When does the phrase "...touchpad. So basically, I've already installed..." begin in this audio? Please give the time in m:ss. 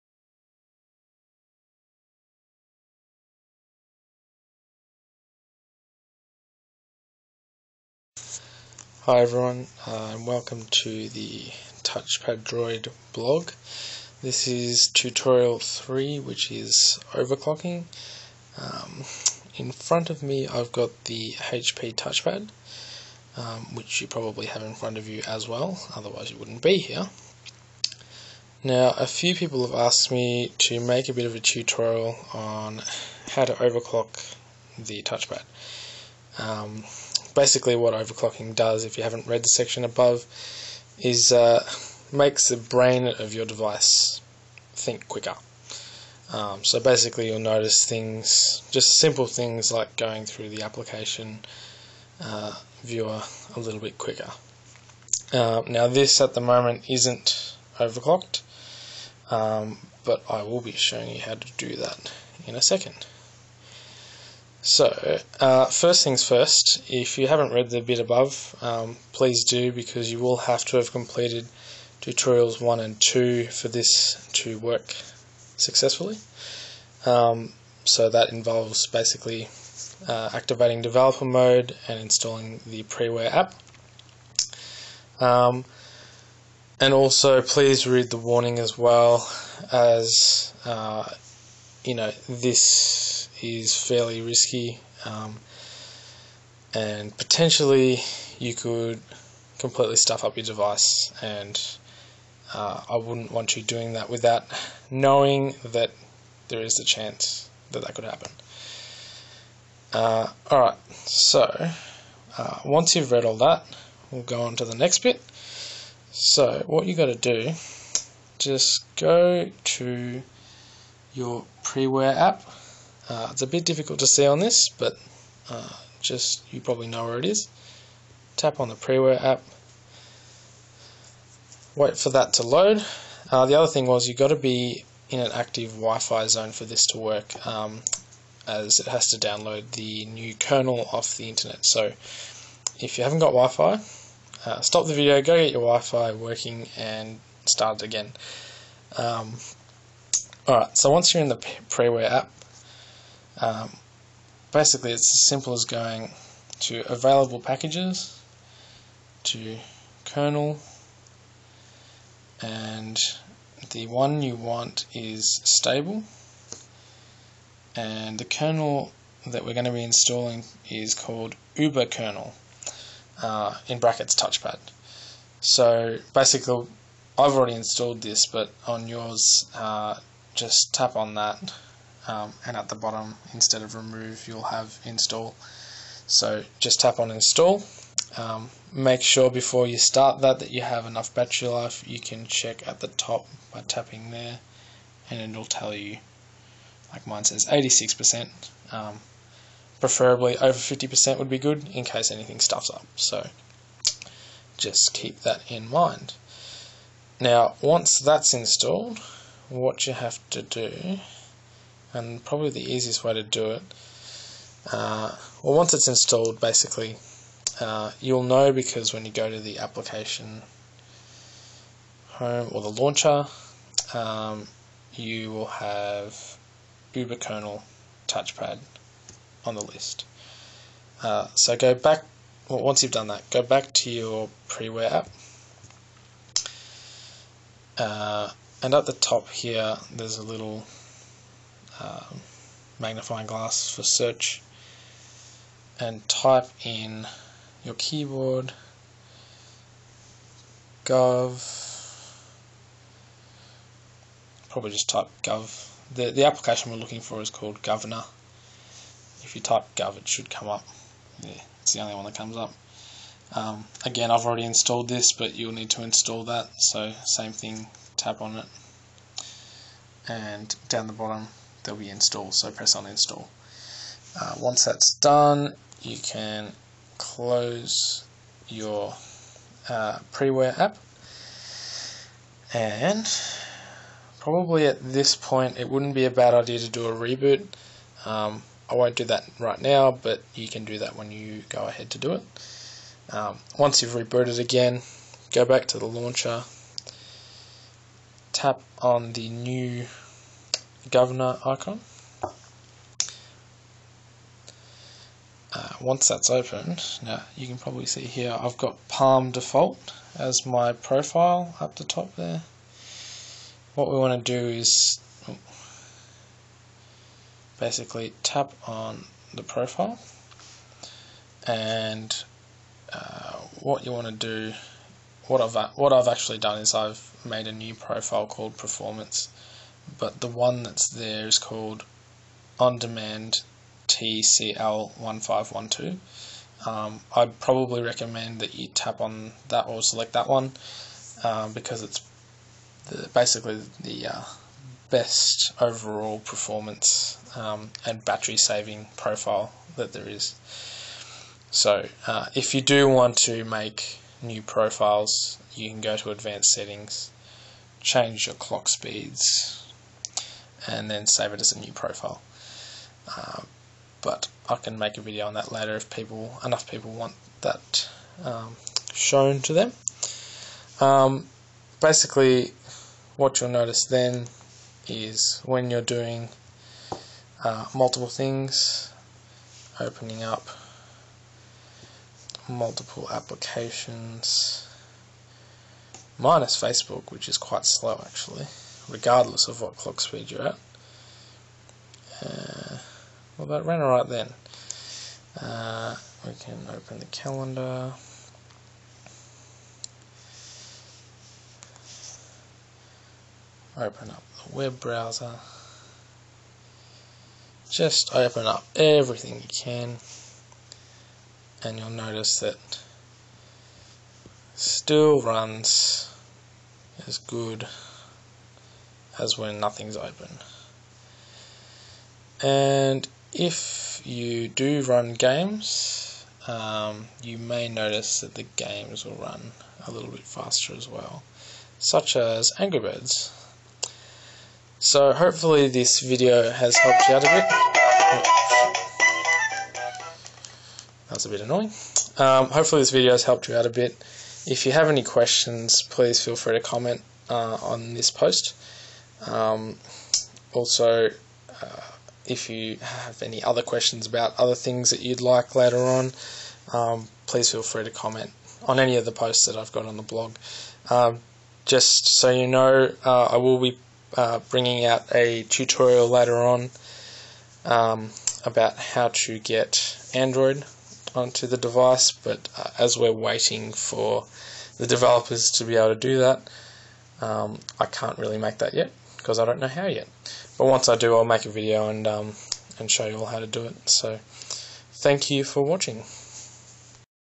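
2:54.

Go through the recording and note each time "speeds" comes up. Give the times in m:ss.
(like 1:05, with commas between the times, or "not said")
5:58, 6:30.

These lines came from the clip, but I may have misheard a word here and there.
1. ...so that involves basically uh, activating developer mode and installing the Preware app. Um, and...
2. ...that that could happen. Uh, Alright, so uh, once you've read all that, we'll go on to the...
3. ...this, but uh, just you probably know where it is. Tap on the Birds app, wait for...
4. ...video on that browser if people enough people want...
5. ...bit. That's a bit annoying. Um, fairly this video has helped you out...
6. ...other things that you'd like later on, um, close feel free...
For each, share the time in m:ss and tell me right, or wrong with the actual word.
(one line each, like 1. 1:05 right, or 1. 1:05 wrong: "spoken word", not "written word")
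1. 1:17 right
2. 1:47 right
3. 2:04 wrong: "Preware", not "Birds"
4. 6:05 wrong: "later", not "browser"
5. 7:19 wrong: "hopefully", not "fairly"
6. 7:34 wrong: "please", not "close".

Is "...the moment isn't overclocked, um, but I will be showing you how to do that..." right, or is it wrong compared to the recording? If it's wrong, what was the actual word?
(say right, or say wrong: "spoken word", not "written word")
right.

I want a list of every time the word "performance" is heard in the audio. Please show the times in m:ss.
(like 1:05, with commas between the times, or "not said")
5:28, 5:46.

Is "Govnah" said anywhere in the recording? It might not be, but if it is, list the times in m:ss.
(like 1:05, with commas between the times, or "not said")
4:17, 5:00.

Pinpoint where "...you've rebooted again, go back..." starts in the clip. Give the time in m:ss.
4:53.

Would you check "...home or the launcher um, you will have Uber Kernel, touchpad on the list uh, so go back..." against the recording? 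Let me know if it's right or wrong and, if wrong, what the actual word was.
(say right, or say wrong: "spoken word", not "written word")
right.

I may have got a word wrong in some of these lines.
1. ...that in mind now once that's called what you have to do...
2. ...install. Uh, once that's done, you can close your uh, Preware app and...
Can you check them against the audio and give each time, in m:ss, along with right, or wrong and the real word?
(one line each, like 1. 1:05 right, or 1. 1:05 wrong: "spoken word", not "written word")
1. 3:25 wrong: "installed", not "called"
2. 4:32 right.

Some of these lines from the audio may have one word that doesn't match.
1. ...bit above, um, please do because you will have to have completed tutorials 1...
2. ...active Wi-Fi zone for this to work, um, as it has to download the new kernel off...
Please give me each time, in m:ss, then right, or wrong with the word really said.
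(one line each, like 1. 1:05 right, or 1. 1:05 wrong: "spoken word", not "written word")
1. 1:07 right
2. 2:15 right.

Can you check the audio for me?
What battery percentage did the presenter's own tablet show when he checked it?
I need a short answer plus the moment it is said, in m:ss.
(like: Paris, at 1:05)
86%, at 3:17.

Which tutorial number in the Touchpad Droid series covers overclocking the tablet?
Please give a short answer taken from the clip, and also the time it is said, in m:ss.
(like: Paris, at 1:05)
3, at 0:14.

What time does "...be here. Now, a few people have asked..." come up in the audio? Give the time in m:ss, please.
0:26.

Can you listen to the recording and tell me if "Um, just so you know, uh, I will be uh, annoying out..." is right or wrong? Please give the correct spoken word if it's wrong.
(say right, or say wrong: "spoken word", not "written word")
wrong: "bringing", not "annoying".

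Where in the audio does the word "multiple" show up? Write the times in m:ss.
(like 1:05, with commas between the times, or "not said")
6:17, 6:22.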